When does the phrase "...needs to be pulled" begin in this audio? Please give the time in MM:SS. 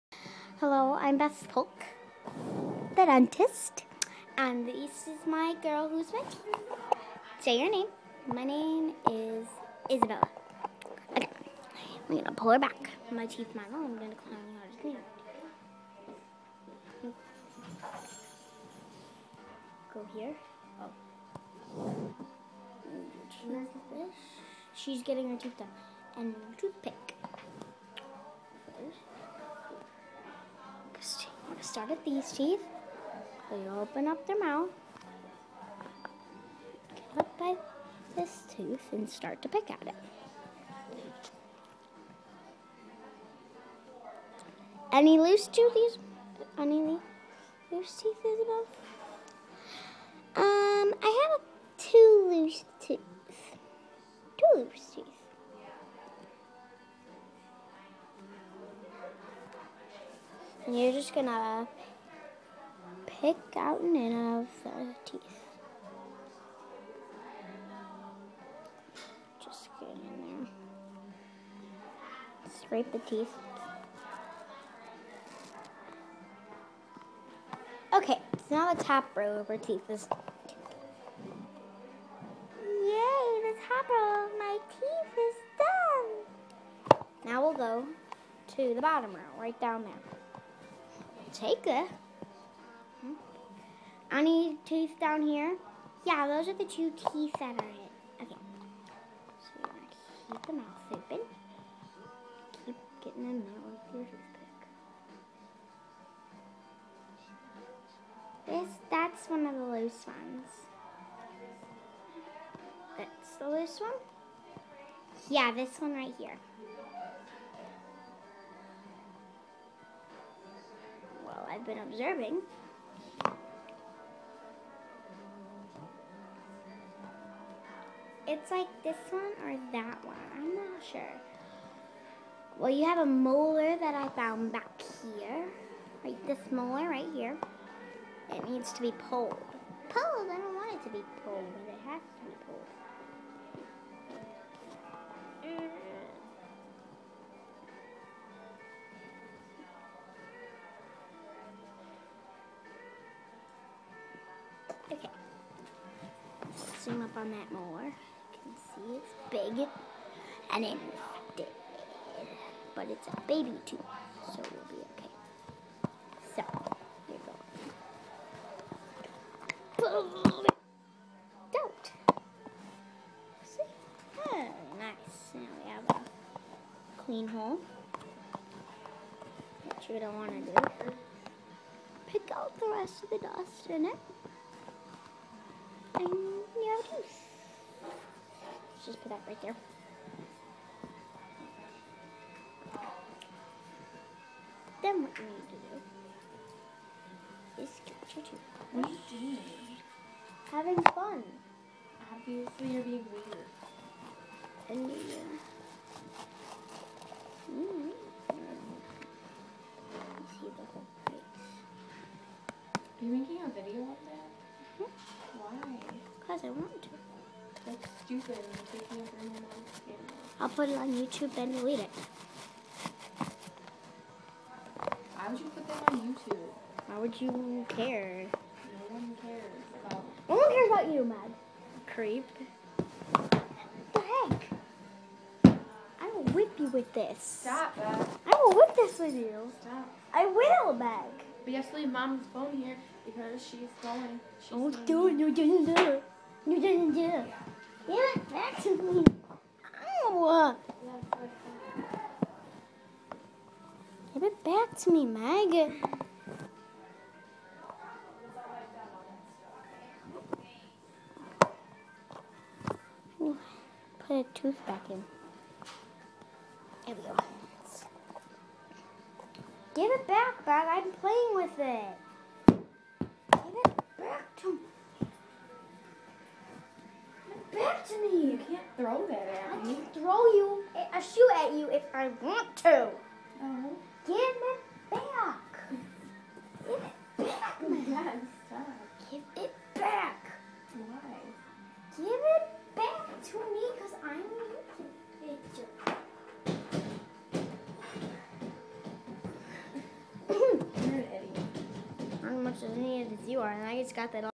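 02:18.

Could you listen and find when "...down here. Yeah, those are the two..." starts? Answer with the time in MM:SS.
01:34.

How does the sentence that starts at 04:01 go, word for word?
But you have to leave mom's phone here because she's going.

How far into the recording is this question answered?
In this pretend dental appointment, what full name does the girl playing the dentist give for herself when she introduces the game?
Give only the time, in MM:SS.
00:01.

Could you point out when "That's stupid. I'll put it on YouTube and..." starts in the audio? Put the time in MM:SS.
03:37.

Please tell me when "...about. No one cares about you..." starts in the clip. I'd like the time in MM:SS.
03:49.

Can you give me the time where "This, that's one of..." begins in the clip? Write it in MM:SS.
01:48.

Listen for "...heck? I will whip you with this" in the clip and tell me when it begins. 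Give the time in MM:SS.
03:53.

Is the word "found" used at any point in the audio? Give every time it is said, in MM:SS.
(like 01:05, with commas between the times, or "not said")
02:14.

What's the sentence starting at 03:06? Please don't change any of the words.
I Let's just put that right there.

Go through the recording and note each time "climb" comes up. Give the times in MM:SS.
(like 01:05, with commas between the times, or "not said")
00:14.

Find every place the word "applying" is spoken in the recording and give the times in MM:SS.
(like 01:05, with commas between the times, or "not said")
not said.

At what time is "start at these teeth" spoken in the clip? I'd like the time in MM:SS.
00:31.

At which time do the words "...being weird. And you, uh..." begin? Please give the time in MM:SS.
03:22.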